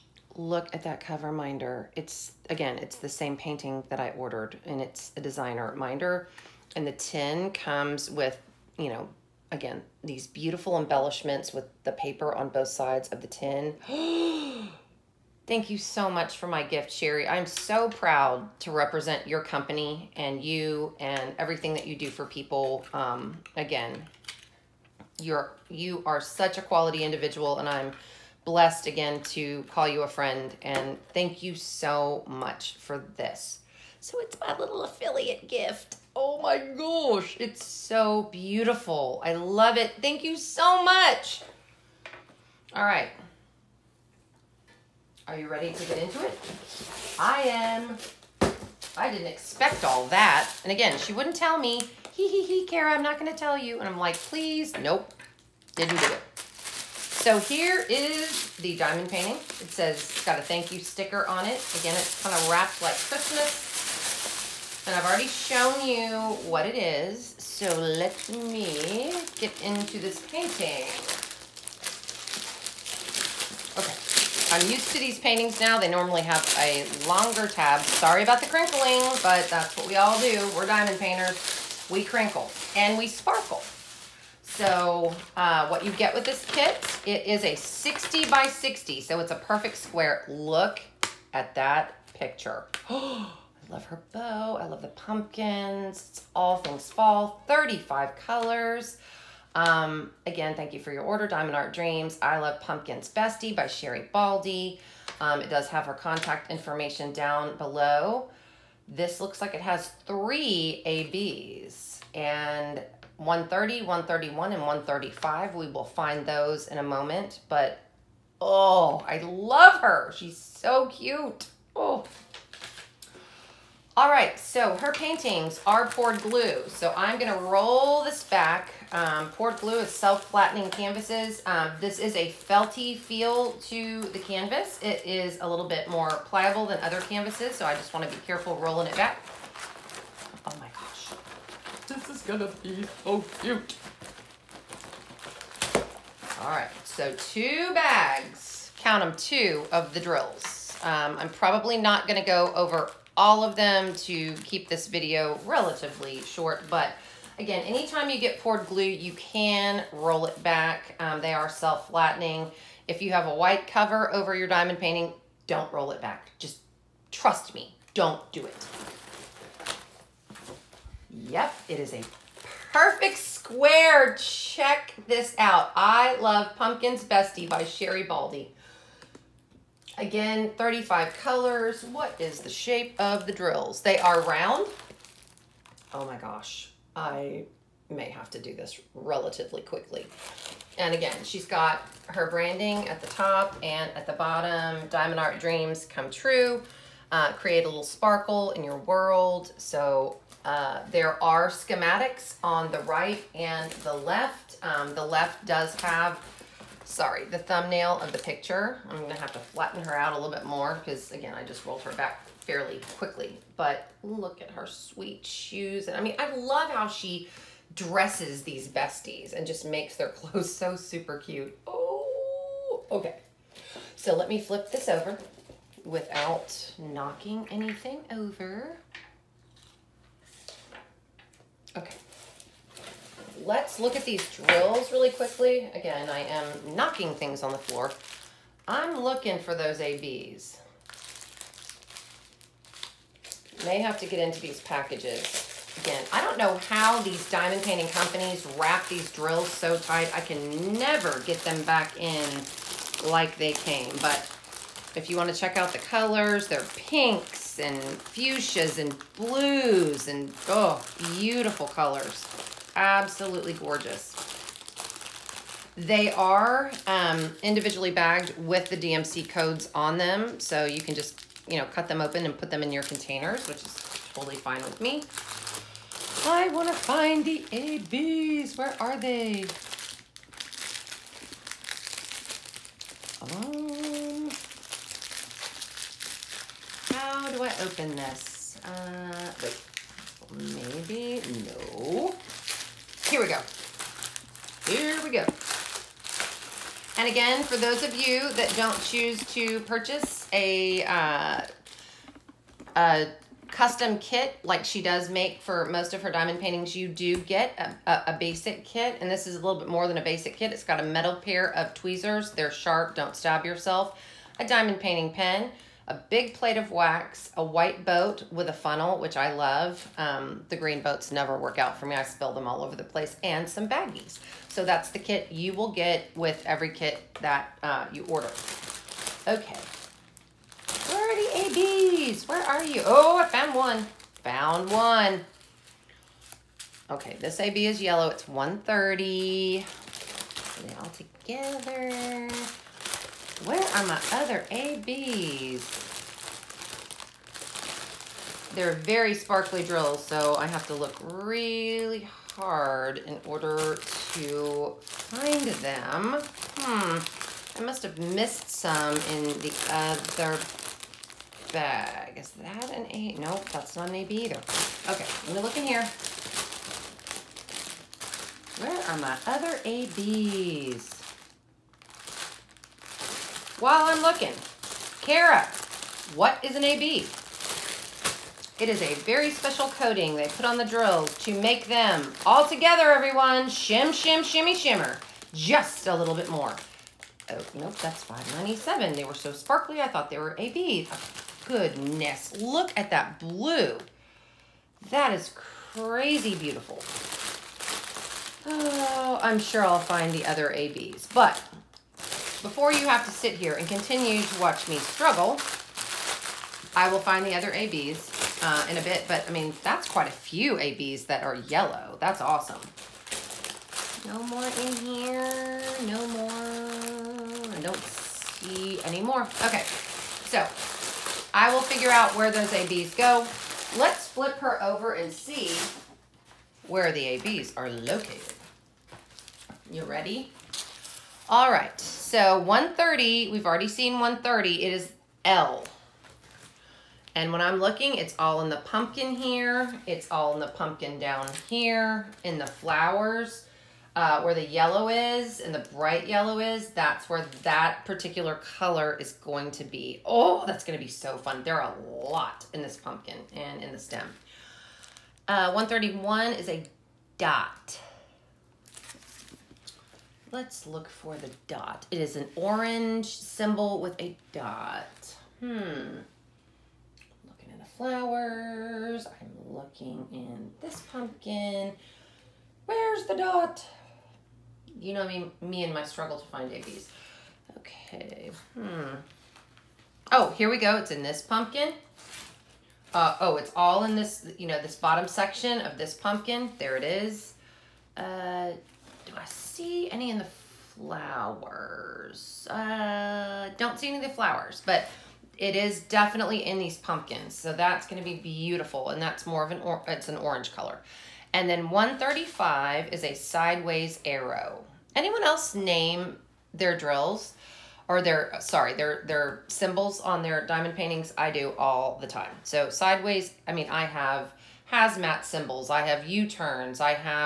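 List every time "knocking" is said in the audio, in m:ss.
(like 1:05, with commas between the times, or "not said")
3:46, 3:56.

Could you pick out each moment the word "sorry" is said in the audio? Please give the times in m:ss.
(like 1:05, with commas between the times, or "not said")
1:17, 3:26, 8:28.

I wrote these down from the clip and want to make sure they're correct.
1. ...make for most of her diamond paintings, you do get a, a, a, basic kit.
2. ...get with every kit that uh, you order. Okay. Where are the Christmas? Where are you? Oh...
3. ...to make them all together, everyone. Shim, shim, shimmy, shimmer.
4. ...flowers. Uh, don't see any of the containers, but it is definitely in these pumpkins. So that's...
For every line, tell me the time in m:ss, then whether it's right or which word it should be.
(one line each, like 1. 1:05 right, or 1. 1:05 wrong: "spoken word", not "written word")
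1. 5:05 right
2. 5:25 wrong: "ABs", not "Christmas"
3. 6:21 right
4. 8:10 wrong: "flowers", not "containers".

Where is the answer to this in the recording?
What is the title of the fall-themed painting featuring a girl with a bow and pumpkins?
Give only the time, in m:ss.
1:42.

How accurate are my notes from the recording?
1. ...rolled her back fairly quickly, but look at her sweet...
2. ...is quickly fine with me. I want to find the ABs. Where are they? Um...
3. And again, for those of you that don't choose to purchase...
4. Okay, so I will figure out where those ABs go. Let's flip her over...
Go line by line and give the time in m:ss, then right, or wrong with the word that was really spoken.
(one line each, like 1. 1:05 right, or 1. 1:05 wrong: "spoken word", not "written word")
1. 3:31 right
2. 4:33 wrong: "totally", not "quickly"
3. 4:56 right
4. 6:59 right.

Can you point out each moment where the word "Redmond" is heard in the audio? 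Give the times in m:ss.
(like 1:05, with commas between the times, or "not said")
not said.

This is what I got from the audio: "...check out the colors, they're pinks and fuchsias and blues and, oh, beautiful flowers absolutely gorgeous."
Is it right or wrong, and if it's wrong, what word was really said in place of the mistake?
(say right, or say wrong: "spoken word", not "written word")
wrong: "colors", not "flowers".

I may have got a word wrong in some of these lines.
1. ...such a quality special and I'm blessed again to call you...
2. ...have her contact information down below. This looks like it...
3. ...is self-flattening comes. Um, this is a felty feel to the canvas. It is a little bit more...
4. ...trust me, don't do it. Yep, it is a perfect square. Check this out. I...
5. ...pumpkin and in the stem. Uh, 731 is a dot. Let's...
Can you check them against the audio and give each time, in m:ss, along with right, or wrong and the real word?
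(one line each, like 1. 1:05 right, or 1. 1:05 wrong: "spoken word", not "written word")
1. 0:26 wrong: "individual", not "special"
2. 1:45 right
3. 2:09 wrong: "canvases", not "comes"
4. 2:47 right
5. 7:32 wrong: "131", not "731".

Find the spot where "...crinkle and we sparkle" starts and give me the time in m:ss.
1:22.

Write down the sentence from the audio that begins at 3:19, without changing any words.
So uh, there are schematics on the right and the left.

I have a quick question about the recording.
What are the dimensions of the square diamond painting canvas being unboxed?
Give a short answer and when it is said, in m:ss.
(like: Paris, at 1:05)
60 by 60, at 1:27.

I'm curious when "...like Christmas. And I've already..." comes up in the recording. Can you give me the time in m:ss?
1:02.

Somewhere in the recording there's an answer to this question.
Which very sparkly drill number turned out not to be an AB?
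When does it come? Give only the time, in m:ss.
6:28.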